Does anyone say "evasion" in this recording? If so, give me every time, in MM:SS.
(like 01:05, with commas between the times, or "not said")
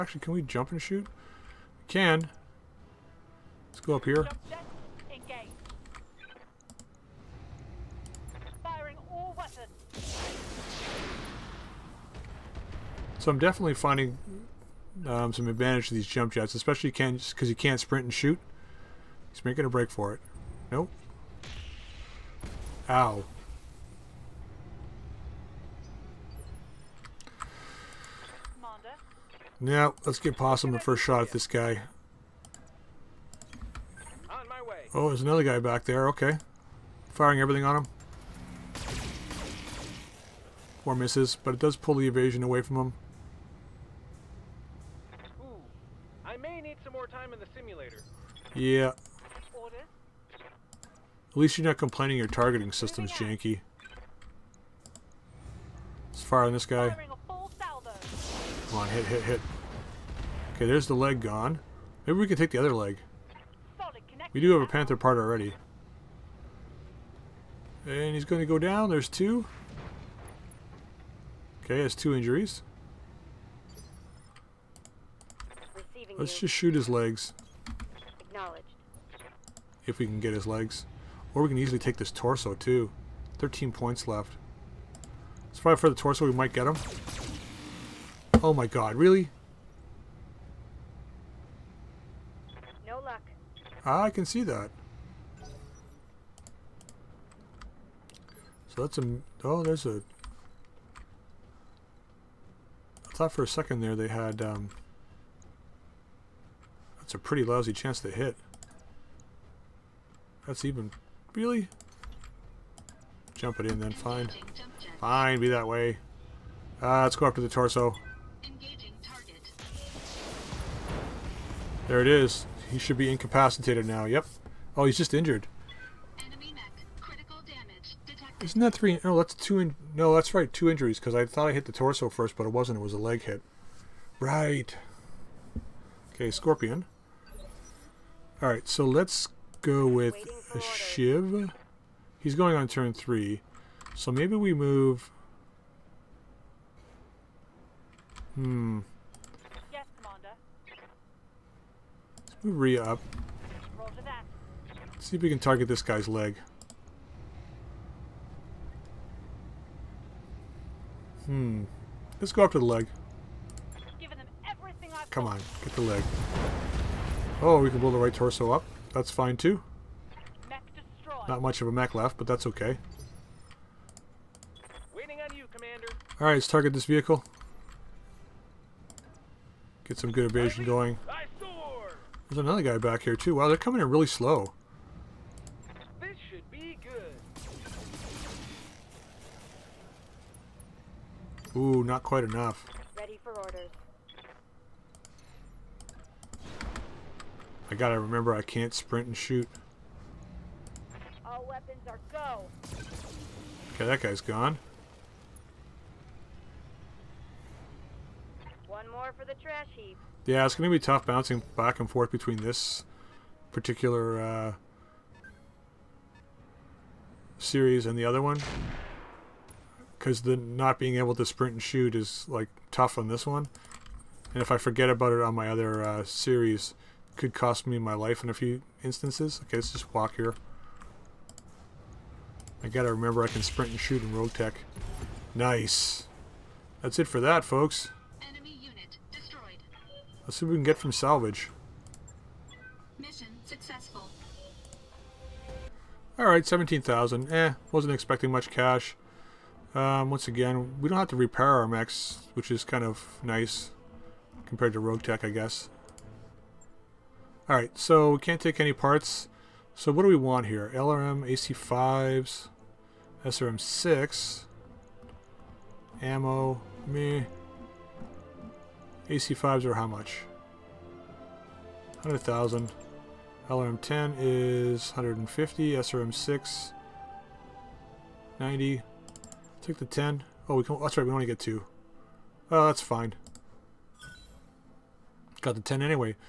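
00:42, 03:00.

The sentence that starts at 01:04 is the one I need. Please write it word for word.
We do have a panther part already.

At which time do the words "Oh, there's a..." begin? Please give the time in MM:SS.
01:39.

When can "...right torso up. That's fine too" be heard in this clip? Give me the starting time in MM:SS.
02:47.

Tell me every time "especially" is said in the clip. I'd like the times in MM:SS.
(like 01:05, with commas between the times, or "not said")
00:16.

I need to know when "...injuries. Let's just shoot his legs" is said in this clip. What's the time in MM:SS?
01:12.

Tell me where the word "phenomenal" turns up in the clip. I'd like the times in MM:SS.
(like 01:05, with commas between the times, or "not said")
not said.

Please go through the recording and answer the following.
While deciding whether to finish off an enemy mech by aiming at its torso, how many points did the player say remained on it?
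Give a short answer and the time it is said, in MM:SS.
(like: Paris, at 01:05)
13, at 01:23.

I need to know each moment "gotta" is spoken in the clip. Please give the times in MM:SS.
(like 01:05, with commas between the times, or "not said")
03:17, 03:52.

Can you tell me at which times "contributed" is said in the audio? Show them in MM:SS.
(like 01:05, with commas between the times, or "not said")
not said.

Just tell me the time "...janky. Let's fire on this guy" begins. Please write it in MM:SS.
00:53.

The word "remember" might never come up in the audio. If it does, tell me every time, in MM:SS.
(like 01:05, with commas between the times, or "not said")
03:17, 03:52.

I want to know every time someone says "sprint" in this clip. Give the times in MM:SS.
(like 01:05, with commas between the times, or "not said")
00:17, 03:18, 03:41, 03:53.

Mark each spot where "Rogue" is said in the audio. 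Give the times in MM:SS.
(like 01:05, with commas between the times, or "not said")
03:54, 04:14.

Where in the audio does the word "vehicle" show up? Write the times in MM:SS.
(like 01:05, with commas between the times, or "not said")
02:56.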